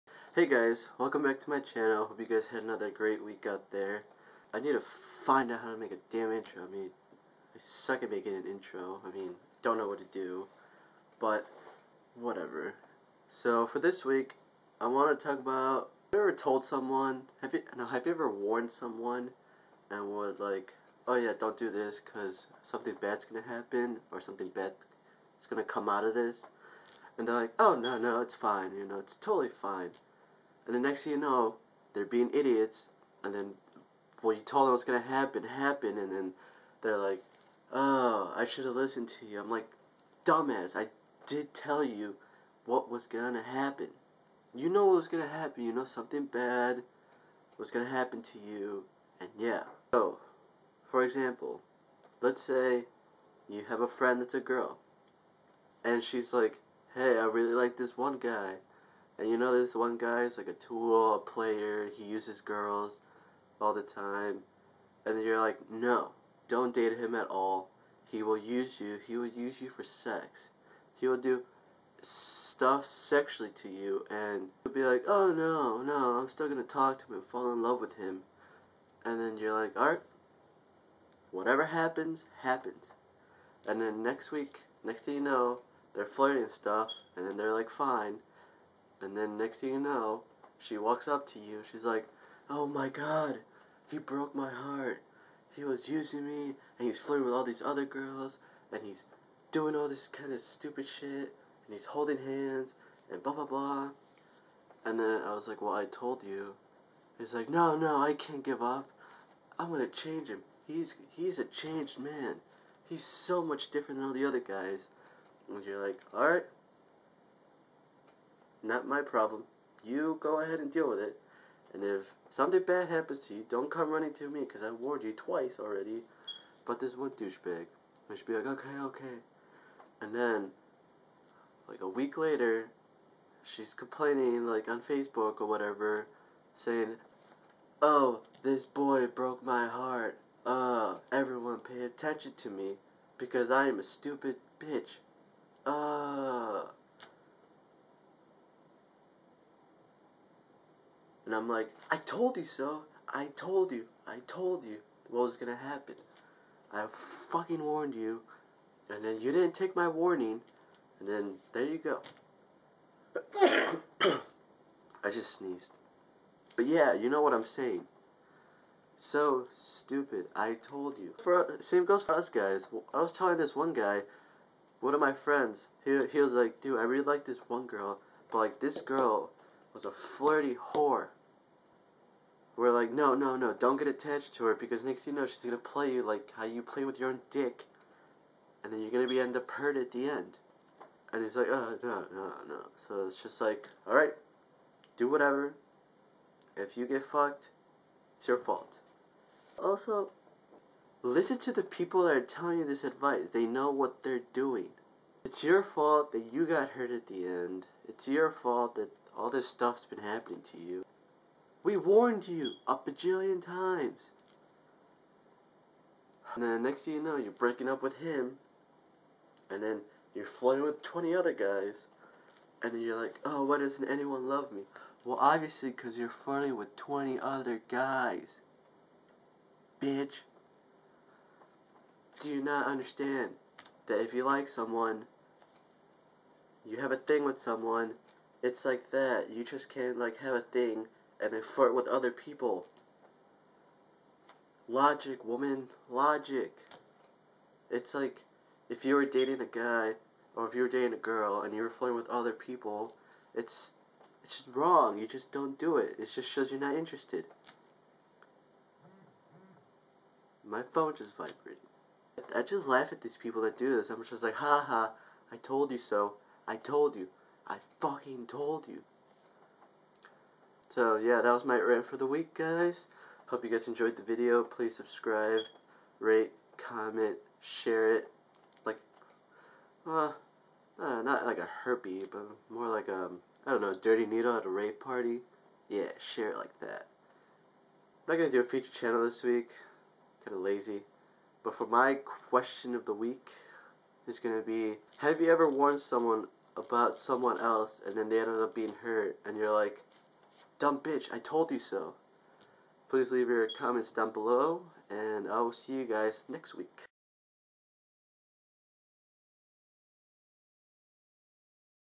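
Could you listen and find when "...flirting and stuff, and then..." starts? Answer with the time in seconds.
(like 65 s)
86 s.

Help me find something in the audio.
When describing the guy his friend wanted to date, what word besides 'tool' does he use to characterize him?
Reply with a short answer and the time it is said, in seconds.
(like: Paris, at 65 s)
a player, at 61 s.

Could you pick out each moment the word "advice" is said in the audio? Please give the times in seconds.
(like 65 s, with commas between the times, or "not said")
202 s.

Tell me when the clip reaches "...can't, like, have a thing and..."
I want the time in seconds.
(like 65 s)
239 s.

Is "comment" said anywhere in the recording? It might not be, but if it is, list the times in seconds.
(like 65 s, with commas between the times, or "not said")
276 s, 303 s.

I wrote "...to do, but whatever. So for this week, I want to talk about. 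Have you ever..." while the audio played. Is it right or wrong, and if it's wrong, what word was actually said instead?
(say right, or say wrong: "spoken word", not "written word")
right.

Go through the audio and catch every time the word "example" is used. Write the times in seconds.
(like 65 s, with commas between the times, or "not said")
51 s.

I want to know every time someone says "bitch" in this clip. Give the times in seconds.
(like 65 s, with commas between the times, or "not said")
144 s, 229 s, 300 s.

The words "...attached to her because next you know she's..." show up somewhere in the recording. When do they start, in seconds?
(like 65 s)
183 s.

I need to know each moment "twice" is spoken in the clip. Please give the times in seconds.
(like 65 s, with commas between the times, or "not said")
125 s.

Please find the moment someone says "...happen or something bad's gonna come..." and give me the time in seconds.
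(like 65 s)
23 s.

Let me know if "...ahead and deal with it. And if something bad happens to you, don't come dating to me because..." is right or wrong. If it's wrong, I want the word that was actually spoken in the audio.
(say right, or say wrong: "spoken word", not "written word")
wrong: "running", not "dating".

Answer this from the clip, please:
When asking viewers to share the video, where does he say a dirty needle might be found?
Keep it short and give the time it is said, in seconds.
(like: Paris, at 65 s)
a rave party, at 284 s.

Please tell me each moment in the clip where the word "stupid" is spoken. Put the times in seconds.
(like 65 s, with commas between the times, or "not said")
100 s, 143 s, 169 s.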